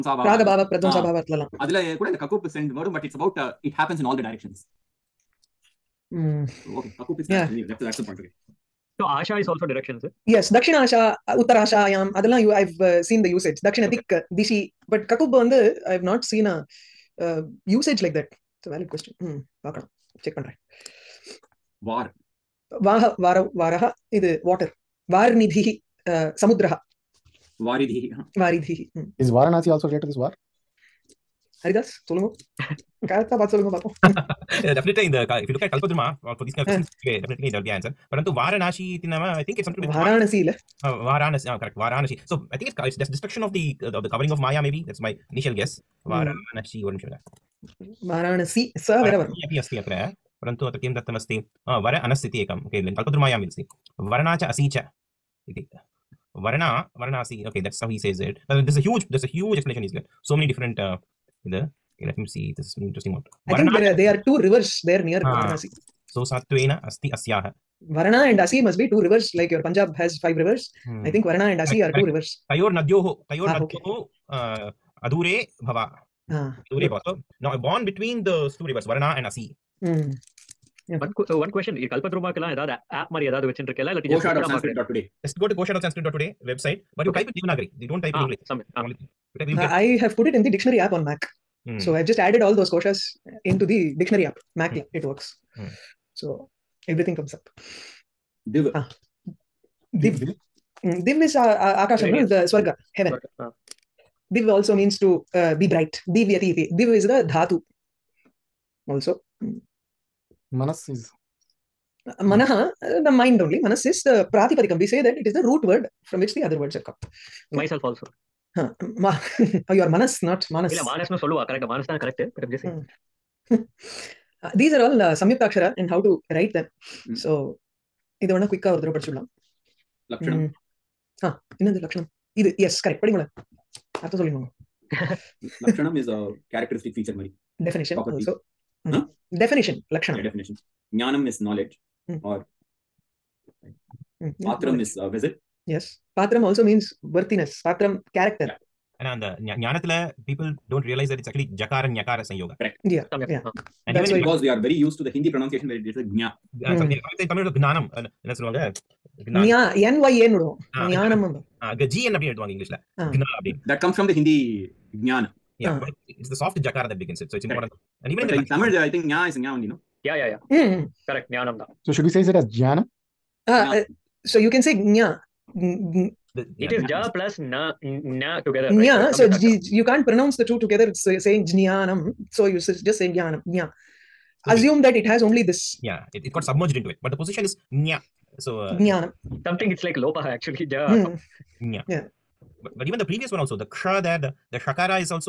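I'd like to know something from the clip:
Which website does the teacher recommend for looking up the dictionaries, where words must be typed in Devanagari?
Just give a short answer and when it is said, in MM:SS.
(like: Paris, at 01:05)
kosha.sanskrit.today, at 01:25.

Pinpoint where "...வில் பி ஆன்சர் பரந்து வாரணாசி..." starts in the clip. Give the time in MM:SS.
00:37.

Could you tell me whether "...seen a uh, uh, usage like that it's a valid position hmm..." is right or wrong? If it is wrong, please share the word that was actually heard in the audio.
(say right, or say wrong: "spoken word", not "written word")
wrong: "question", not "position".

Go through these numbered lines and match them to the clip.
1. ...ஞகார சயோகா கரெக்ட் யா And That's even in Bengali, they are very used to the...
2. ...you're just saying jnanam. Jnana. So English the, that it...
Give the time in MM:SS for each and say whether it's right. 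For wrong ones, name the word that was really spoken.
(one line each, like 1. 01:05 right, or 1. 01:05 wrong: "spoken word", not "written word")
1. 02:31 right
2. 03:02 wrong: "Assume", not "English".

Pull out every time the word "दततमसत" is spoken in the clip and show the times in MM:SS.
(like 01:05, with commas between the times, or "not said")
00:50.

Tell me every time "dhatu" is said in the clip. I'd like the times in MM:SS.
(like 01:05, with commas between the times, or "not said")
01:47.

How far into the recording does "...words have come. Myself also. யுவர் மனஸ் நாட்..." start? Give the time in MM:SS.
01:56.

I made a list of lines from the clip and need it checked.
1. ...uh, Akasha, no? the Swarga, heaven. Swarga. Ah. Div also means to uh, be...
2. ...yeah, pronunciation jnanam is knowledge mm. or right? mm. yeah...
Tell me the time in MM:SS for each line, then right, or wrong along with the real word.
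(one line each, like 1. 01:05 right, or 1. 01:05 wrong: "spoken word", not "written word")
1. 01:41 right
2. 02:20 wrong: "definition", not "pronunciation".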